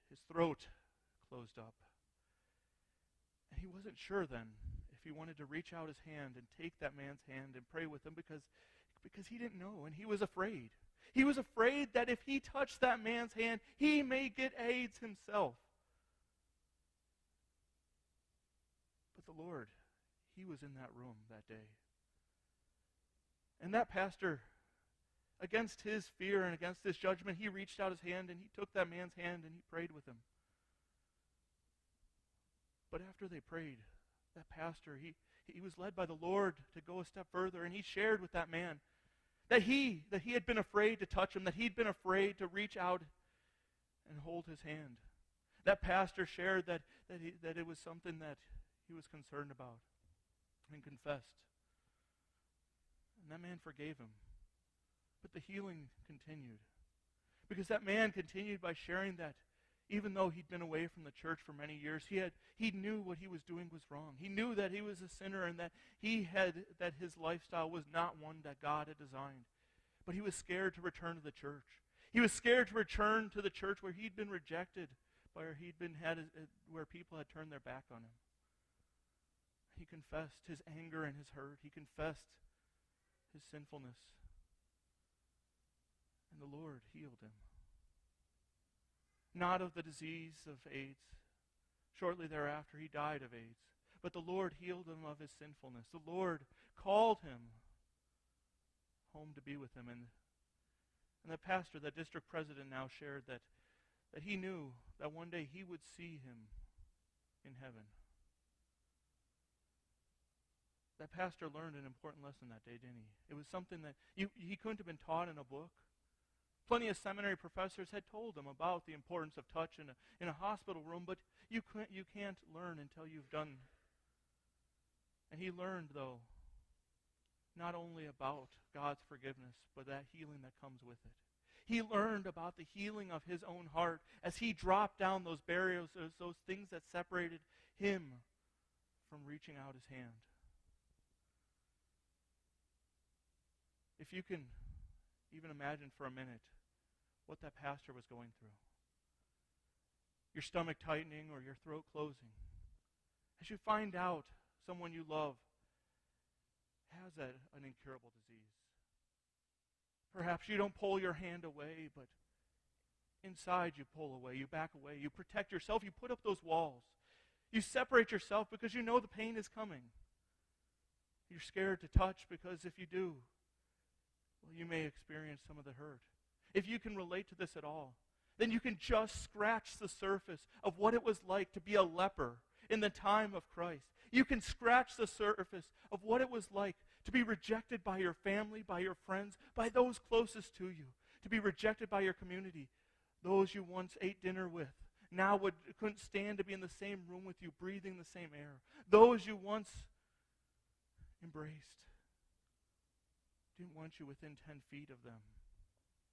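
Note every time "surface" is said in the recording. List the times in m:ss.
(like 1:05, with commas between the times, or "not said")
2:59, 3:05.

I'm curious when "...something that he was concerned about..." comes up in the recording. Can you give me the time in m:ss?
0:47.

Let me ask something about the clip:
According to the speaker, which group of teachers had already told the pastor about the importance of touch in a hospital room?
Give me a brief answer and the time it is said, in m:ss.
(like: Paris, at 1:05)
seminary professors, at 1:56.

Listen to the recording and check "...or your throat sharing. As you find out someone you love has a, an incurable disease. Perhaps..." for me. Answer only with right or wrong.
wrong.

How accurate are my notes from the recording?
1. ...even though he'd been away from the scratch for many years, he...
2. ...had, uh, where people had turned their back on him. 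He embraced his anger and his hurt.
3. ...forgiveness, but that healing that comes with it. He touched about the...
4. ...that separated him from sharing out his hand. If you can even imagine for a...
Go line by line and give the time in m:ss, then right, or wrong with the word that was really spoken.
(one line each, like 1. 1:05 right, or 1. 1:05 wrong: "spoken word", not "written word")
1. 0:59 wrong: "church", not "scratch"
2. 1:16 wrong: "confessed", not "embraced"
3. 2:09 wrong: "learned", not "touched"
4. 2:16 wrong: "reaching", not "sharing".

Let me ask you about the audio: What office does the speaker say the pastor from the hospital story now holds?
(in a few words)
district president.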